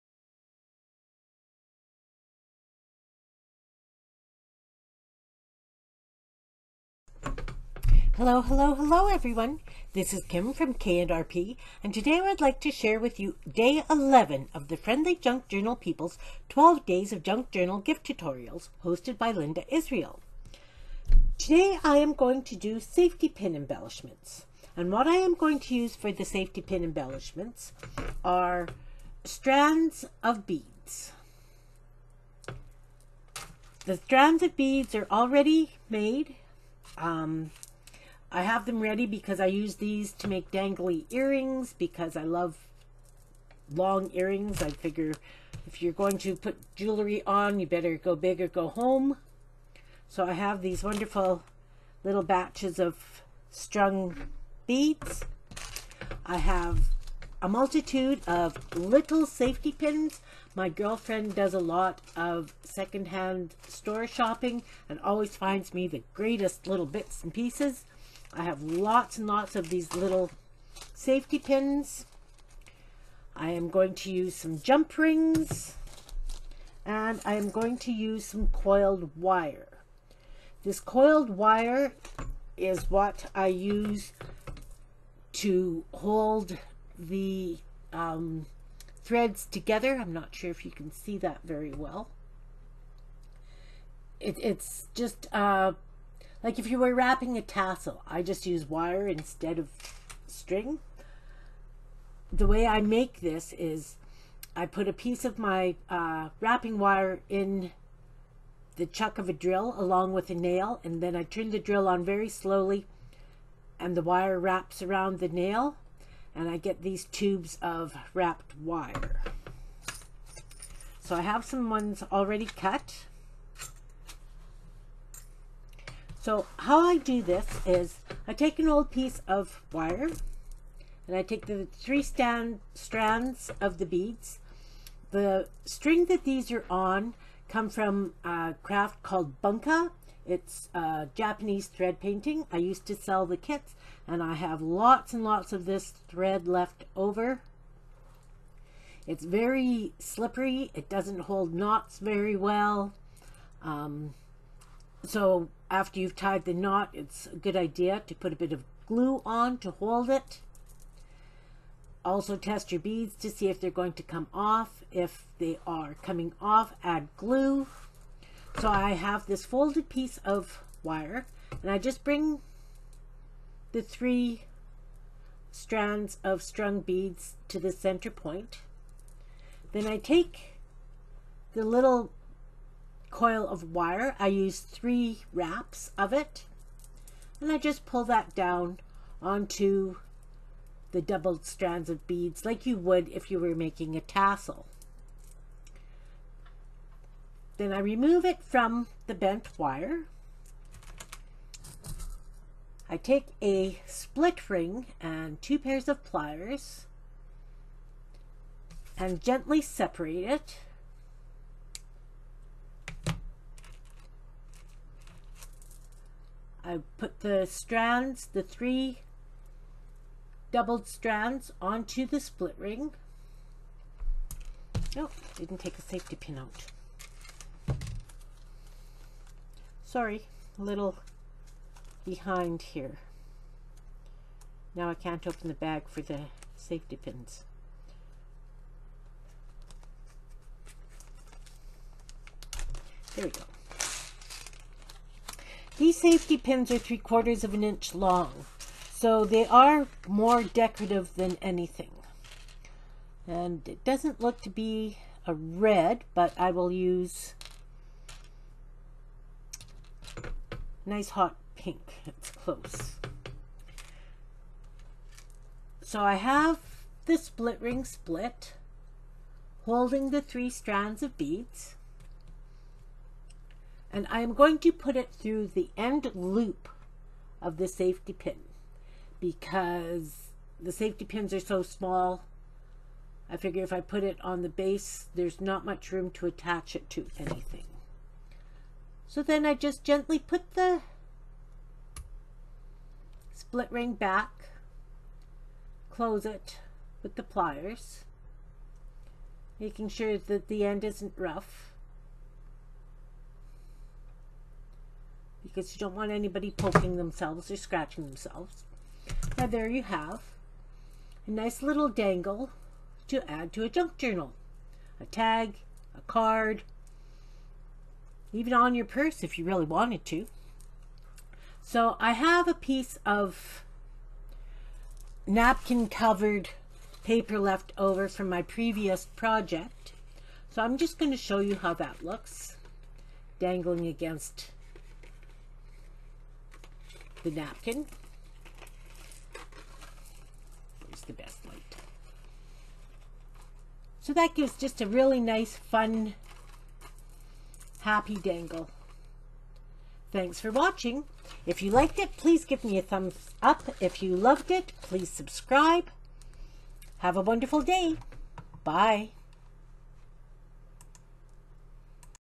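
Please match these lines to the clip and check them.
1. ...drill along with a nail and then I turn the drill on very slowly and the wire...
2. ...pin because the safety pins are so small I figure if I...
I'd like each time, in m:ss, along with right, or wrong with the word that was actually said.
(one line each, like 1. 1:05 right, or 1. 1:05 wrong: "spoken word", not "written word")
1. 1:49 right
2. 4:38 right.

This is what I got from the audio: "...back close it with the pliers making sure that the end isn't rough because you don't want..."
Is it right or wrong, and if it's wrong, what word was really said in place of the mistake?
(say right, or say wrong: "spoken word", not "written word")
right.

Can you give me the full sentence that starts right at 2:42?
Also test your beads to see if they're going to come off.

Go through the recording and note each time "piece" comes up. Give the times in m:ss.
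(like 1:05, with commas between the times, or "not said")
1:07, 1:44, 2:08, 2:49, 5:22.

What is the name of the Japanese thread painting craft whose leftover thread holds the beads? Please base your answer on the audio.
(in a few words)
Bunka.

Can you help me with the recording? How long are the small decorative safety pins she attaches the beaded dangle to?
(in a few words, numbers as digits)
3/4 inch.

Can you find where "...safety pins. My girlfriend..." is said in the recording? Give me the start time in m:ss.
0:59.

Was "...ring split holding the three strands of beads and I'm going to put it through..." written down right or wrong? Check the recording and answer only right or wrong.
right.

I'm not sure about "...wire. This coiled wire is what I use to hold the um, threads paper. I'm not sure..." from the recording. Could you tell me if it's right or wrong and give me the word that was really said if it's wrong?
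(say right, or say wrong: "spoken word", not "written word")
wrong: "together", not "paper".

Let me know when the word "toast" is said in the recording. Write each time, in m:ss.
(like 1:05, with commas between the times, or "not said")
not said.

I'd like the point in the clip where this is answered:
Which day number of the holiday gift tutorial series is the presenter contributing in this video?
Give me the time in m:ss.
0:13.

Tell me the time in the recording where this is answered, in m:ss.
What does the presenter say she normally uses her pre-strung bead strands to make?
0:40.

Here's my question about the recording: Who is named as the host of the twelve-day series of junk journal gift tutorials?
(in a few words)
Linda Israel.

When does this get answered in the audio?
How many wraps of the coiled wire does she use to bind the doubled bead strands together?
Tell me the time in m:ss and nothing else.
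3:04.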